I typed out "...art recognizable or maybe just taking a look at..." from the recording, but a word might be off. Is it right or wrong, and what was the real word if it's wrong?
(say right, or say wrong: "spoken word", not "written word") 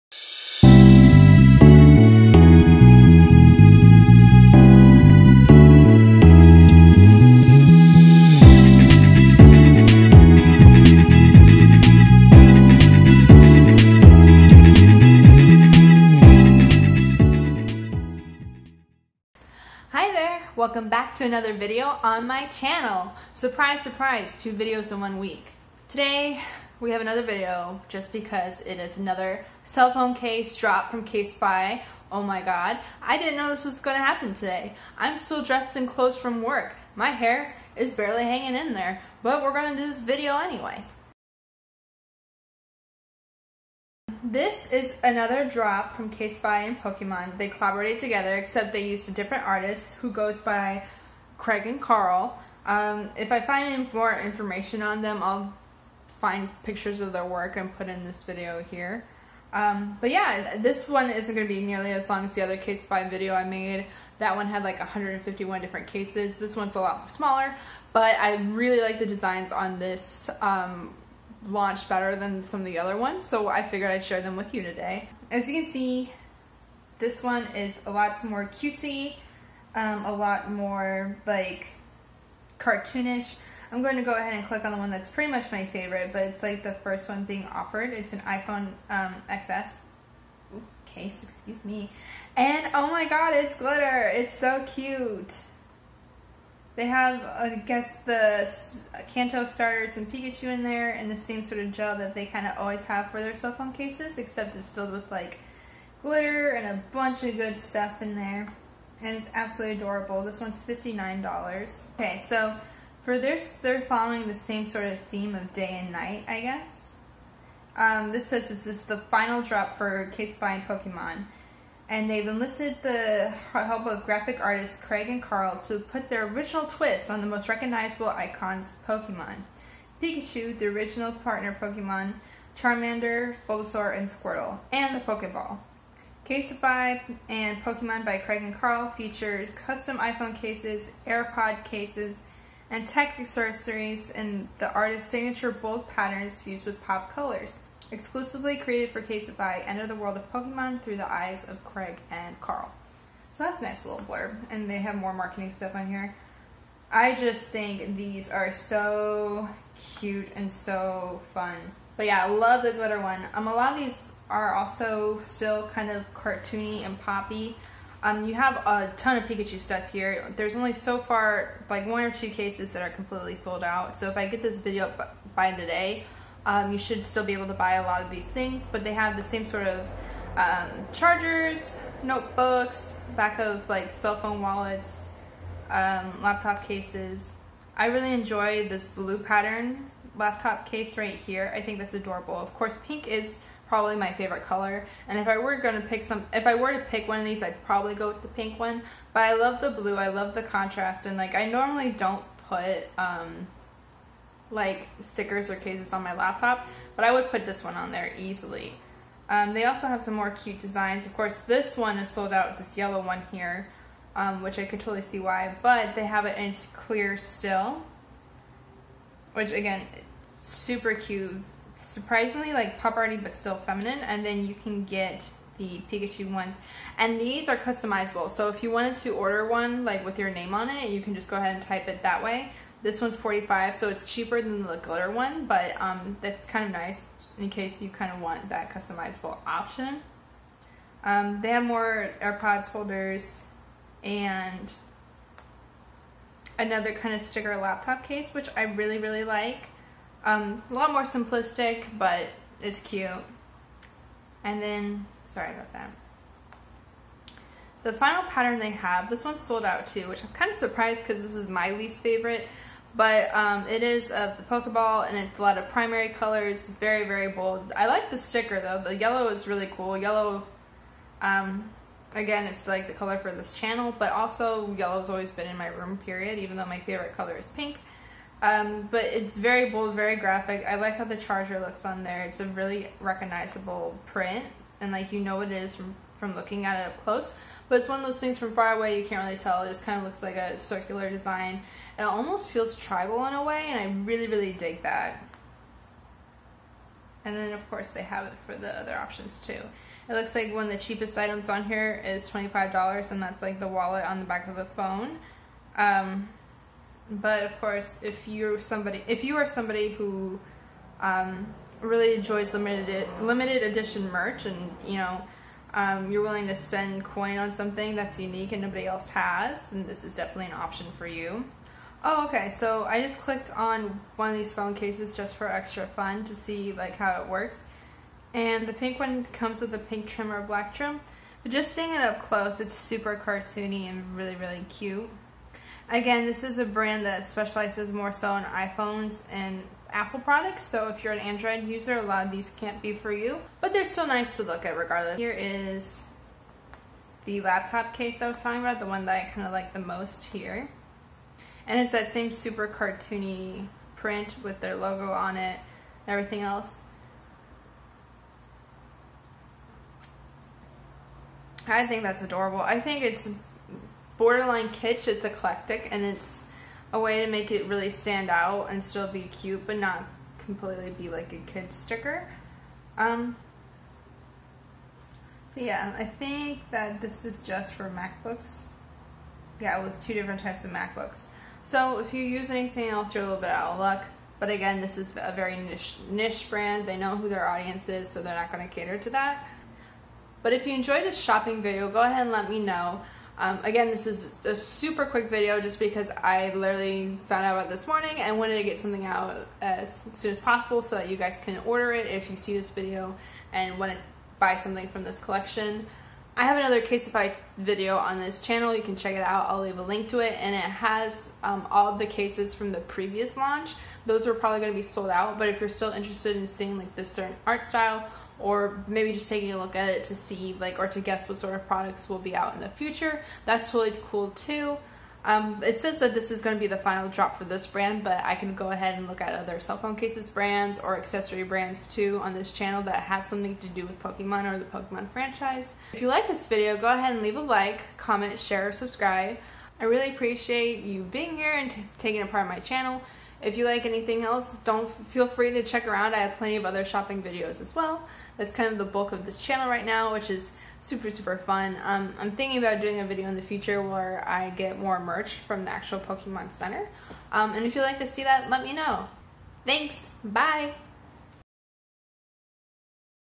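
wrong: "style", not "recognizable".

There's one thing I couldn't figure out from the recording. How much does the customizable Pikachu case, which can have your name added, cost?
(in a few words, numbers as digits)
45.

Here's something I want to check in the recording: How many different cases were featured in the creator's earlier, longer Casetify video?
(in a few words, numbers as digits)
151.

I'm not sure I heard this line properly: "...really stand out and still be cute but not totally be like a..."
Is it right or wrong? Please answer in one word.
wrong.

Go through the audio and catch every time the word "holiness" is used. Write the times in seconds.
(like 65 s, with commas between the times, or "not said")
not said.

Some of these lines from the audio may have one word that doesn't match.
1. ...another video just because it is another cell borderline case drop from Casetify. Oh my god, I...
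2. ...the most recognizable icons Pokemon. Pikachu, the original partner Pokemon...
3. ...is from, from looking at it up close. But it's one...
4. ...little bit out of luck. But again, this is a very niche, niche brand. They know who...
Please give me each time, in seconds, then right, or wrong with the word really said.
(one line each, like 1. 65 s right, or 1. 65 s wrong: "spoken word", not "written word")
1. 26 s wrong: "phone", not "borderline"
2. 127 s right
3. 285 s right
4. 383 s right.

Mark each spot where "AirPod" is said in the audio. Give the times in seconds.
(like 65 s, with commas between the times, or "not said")
141 s, 242 s.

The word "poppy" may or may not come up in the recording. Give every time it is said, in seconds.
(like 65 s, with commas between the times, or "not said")
166 s.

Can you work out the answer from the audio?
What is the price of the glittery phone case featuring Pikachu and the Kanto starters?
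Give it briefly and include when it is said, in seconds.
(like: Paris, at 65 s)
$59, at 110 s.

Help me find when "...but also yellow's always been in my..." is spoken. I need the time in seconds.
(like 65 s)
273 s.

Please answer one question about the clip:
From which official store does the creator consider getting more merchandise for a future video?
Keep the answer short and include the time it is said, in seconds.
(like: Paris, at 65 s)
Pokemon Center, at 455 s.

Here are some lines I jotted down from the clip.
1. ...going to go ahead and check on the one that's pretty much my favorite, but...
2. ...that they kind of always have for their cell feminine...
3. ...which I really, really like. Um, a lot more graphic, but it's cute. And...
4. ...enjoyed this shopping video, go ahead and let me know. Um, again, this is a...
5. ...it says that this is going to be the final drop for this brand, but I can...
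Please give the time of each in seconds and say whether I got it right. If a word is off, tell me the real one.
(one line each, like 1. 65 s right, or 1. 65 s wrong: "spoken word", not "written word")
1. 83 s wrong: "click", not "check"
2. 101 s wrong: "phone", not "feminine"
3. 248 s wrong: "simplistic", not "graphic"
4. 390 s right
5. 425 s right.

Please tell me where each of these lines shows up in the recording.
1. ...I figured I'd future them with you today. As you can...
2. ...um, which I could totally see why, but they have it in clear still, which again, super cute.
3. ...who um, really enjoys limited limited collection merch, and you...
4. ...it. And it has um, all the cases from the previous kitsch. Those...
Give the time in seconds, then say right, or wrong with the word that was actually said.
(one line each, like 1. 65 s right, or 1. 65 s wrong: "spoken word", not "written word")
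1. 73 s wrong: "share", not "future"
2. 214 s right
3. 309 s wrong: "edition", not "collection"
4. 410 s wrong: "launch", not "kitsch".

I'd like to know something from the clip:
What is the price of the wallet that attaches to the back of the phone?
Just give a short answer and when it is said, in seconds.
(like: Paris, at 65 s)
$25, at 302 s.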